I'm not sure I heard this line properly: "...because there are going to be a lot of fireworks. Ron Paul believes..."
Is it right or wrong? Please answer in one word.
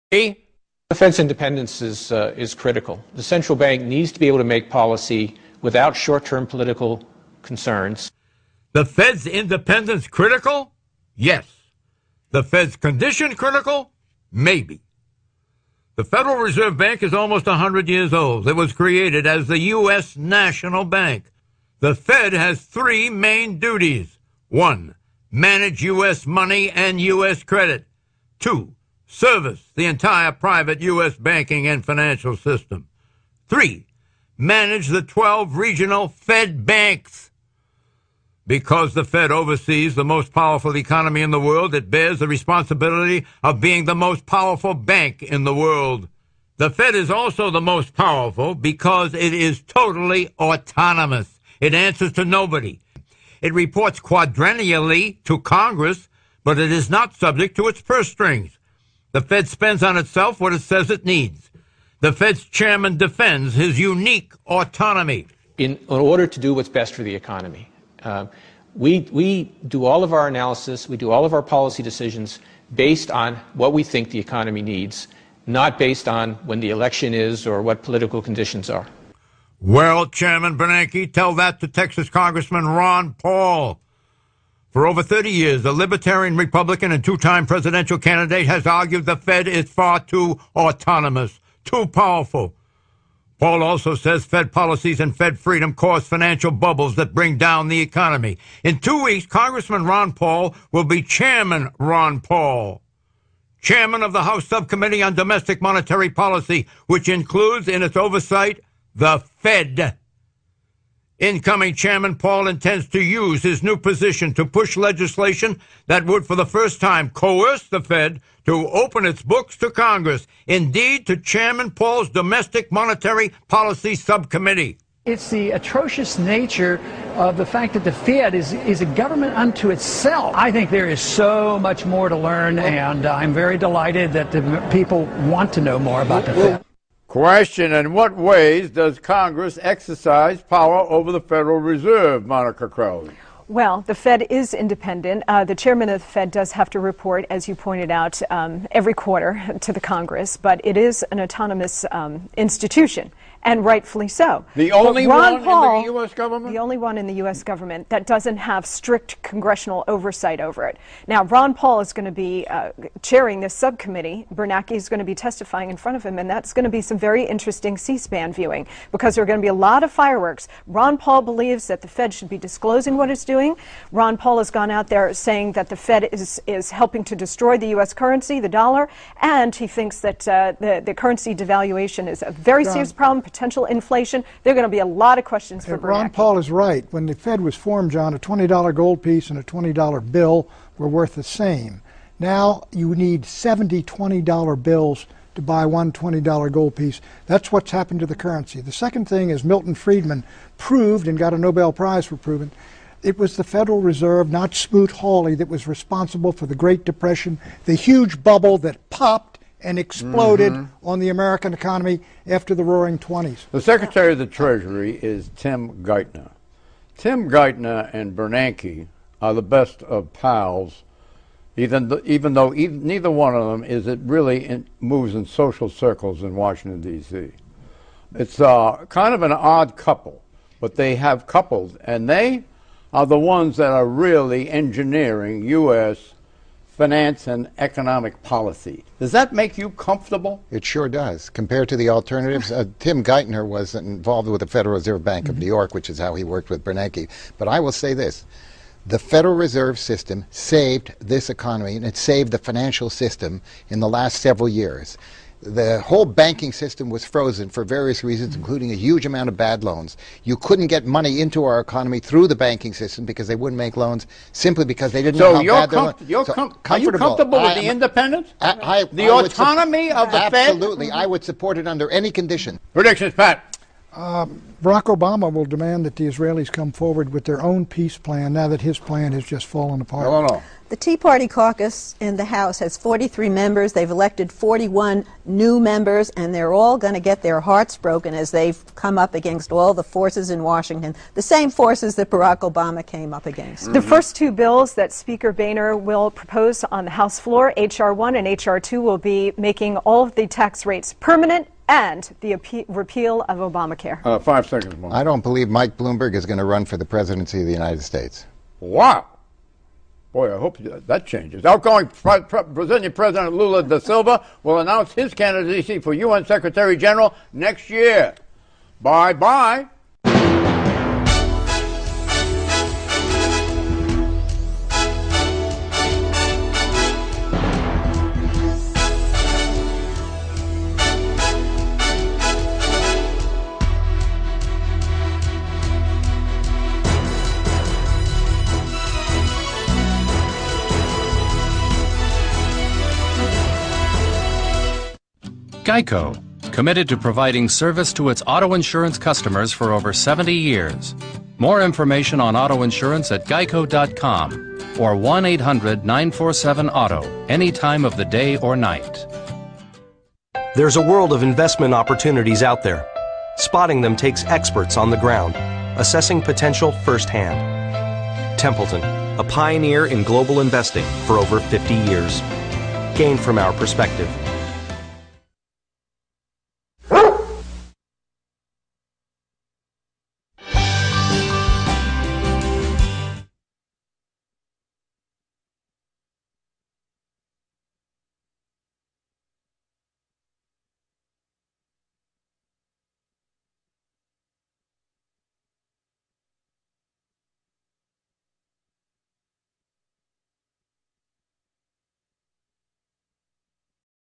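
right.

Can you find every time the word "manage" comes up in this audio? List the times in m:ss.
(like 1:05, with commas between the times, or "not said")
0:25, 0:34.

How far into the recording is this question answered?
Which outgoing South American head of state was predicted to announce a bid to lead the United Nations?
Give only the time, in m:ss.
5:13.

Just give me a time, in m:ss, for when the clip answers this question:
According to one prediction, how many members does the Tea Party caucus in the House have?
4:42.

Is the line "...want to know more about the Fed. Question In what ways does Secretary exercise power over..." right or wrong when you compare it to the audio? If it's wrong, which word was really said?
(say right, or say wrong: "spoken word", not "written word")
wrong: "Congress", not "Secretary".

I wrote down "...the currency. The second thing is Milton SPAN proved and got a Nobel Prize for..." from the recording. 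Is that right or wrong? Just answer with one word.
wrong.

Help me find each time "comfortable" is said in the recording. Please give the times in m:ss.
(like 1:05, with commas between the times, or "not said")
3:59, 4:26.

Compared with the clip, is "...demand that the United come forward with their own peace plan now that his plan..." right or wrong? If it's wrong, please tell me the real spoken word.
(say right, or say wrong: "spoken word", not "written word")
wrong: "Israelis", not "United".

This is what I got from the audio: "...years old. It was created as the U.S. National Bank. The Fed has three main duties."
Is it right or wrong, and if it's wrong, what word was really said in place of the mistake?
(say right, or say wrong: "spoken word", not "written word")
right.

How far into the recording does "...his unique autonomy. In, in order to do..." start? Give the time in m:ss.
1:03.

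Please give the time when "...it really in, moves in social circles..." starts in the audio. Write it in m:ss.
3:43.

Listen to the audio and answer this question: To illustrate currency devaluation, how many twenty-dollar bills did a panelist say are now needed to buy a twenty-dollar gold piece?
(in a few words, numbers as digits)
70.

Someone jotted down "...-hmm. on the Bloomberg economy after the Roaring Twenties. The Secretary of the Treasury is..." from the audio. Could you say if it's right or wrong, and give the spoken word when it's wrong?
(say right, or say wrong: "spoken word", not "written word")
wrong: "American", not "Bloomberg".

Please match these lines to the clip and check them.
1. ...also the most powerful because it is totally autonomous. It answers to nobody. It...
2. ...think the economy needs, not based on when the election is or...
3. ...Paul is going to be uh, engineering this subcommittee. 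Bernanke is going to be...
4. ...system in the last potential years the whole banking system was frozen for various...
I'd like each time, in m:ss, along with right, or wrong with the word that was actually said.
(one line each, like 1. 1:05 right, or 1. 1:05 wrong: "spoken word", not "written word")
1. 0:47 right
2. 1:13 right
3. 2:41 wrong: "chairing", not "engineering"
4. 4:12 wrong: "several", not "potential".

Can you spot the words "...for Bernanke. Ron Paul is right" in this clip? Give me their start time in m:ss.
3:05.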